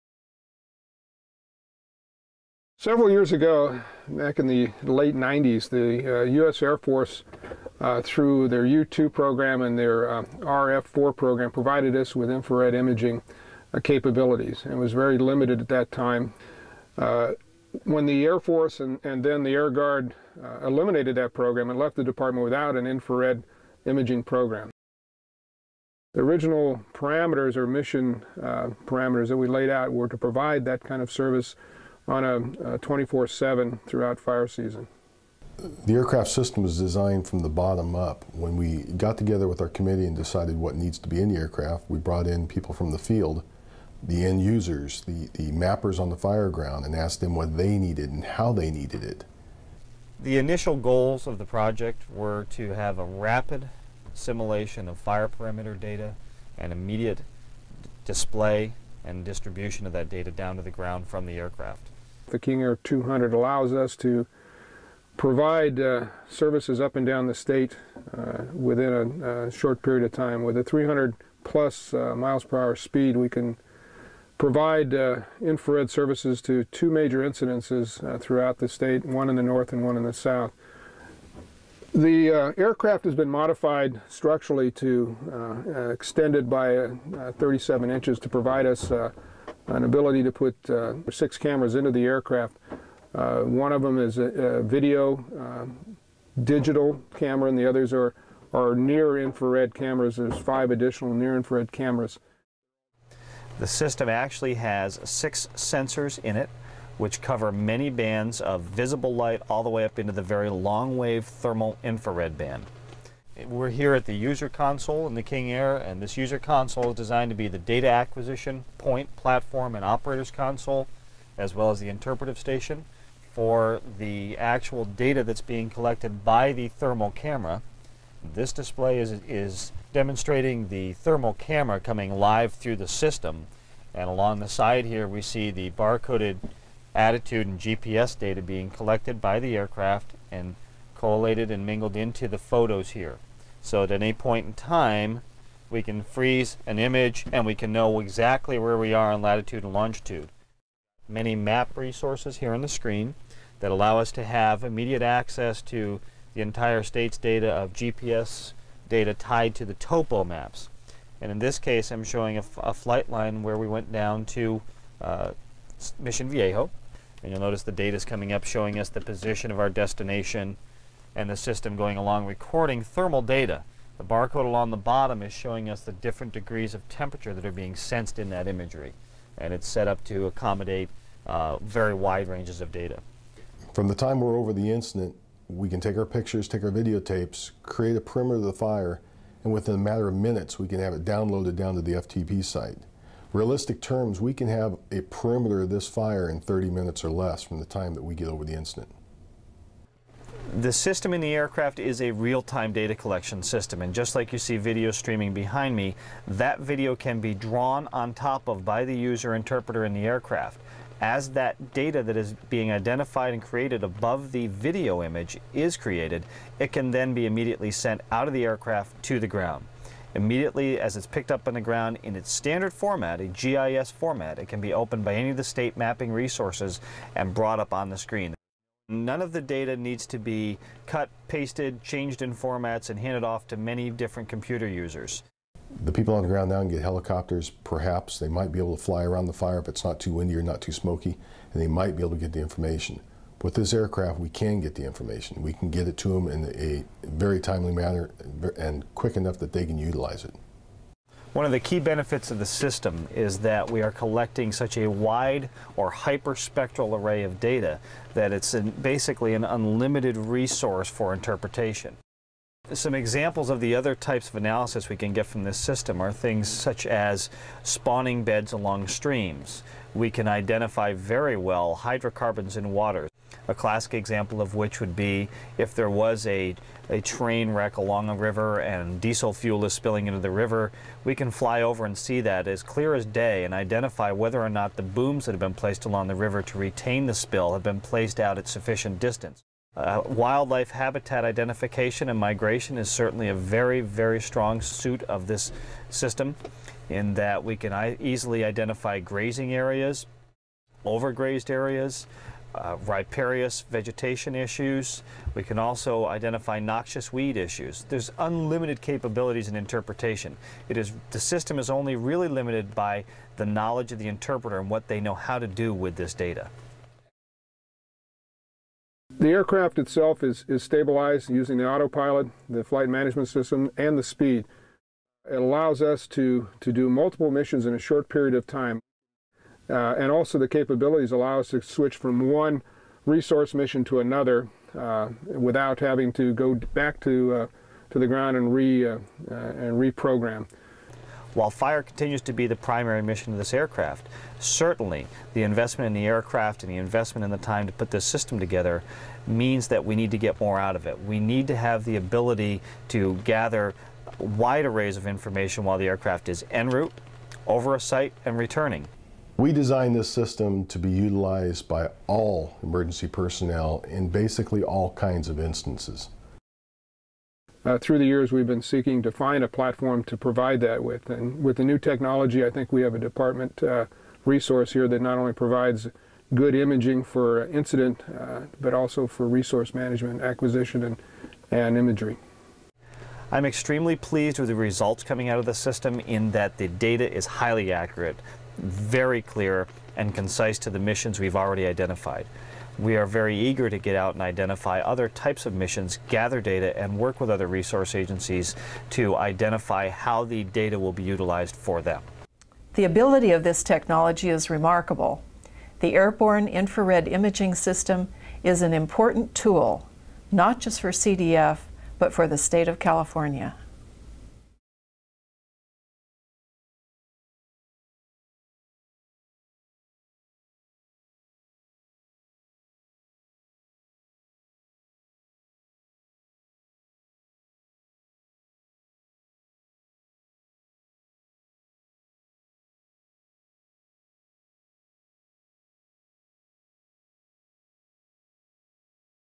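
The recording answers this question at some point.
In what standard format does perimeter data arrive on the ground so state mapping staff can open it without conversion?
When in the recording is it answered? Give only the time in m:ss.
3:43.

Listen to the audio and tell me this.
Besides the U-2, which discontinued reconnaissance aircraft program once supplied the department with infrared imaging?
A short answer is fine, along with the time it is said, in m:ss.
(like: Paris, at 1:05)
RF-4, at 0:10.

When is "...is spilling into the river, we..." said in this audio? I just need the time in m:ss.
4:39.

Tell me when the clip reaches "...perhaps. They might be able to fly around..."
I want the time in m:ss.
3:57.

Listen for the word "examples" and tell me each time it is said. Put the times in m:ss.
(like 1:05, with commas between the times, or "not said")
4:22, 4:33.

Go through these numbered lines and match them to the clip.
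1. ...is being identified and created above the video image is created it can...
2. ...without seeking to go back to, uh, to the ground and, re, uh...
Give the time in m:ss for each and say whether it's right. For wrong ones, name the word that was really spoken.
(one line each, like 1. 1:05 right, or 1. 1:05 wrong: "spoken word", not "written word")
1. 3:32 right
2. 5:35 wrong: "having", not "seeking".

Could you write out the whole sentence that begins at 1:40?
There's five additional near infrared cameras.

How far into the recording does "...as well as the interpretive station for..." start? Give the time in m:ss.
2:01.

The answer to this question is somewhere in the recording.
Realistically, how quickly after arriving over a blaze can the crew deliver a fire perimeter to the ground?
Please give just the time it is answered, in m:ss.
3:16.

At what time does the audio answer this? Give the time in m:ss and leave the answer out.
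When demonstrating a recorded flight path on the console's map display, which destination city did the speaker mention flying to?
2:45.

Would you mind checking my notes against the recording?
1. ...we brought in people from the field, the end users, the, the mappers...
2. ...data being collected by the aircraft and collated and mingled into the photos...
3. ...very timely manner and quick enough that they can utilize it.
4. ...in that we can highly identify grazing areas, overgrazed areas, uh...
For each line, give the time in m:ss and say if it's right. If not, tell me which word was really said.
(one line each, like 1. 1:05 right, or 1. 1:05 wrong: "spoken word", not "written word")
1. 0:41 right
2. 2:18 right
3. 4:07 right
4. 4:56 wrong: "easily", not "highly".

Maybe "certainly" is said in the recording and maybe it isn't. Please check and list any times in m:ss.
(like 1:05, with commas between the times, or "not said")
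4:52, 5:44.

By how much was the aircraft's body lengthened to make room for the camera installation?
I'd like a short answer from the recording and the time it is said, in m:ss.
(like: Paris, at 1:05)
37 inches, at 1:27.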